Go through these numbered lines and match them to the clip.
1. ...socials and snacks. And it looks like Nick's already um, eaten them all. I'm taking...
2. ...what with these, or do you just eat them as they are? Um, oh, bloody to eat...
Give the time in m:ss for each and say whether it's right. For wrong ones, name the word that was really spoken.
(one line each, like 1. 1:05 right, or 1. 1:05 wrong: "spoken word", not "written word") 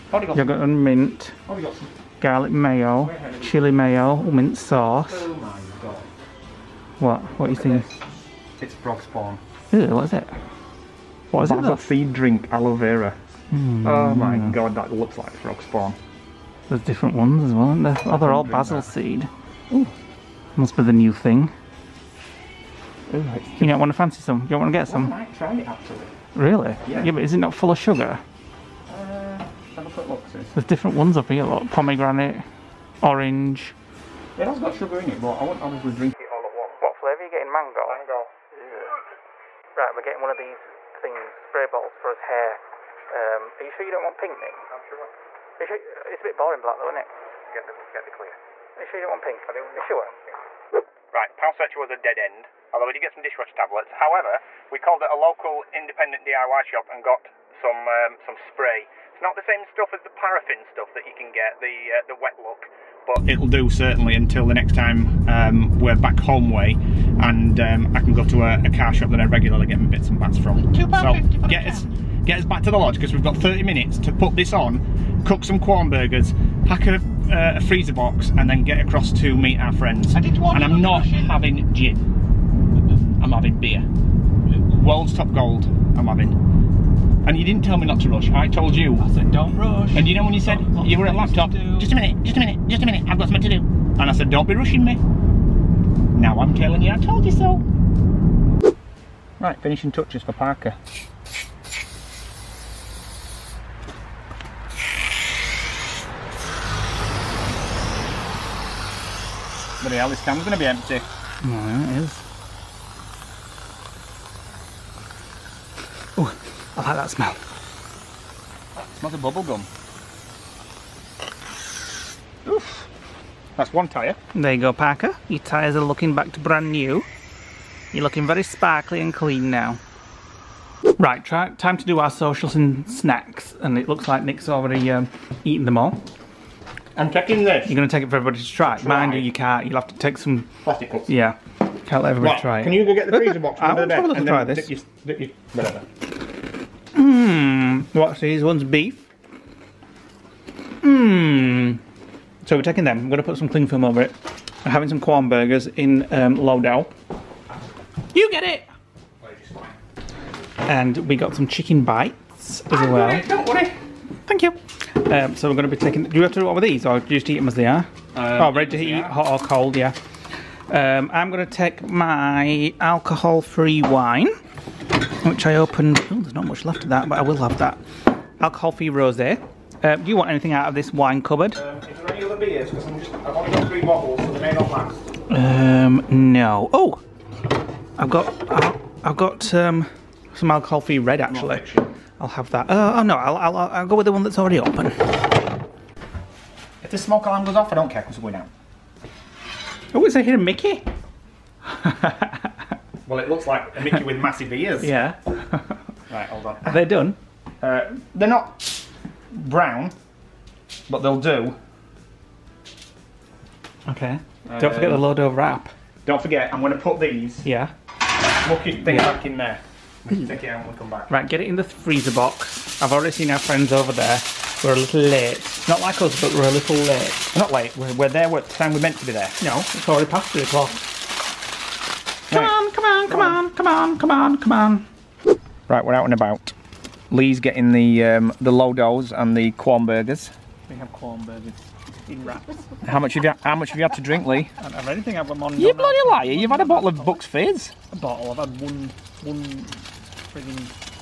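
1. 2:12 right
2. 2:46 wrong: "ready", not "bloody".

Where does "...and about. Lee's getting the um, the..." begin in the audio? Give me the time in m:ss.
3:56.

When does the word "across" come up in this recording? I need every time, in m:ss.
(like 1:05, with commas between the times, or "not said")
1:18.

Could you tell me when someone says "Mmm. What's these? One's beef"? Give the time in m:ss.
2:26.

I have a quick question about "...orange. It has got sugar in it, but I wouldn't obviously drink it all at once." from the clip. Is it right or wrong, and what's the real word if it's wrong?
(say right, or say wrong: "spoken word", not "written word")
right.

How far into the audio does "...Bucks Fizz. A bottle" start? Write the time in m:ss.
4:07.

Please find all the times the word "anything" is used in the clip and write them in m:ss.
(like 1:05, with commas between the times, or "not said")
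3:00, 4:04.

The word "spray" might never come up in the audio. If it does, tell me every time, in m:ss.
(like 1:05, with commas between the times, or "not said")
0:41, 0:58.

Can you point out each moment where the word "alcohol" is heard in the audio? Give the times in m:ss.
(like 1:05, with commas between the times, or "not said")
2:52, 2:58, 3:10.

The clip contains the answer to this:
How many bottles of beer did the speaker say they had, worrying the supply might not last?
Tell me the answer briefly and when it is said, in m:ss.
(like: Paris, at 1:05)
3, at 3:03.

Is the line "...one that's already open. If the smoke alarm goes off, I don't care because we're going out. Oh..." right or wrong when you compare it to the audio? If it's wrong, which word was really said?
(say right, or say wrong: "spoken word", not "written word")
right.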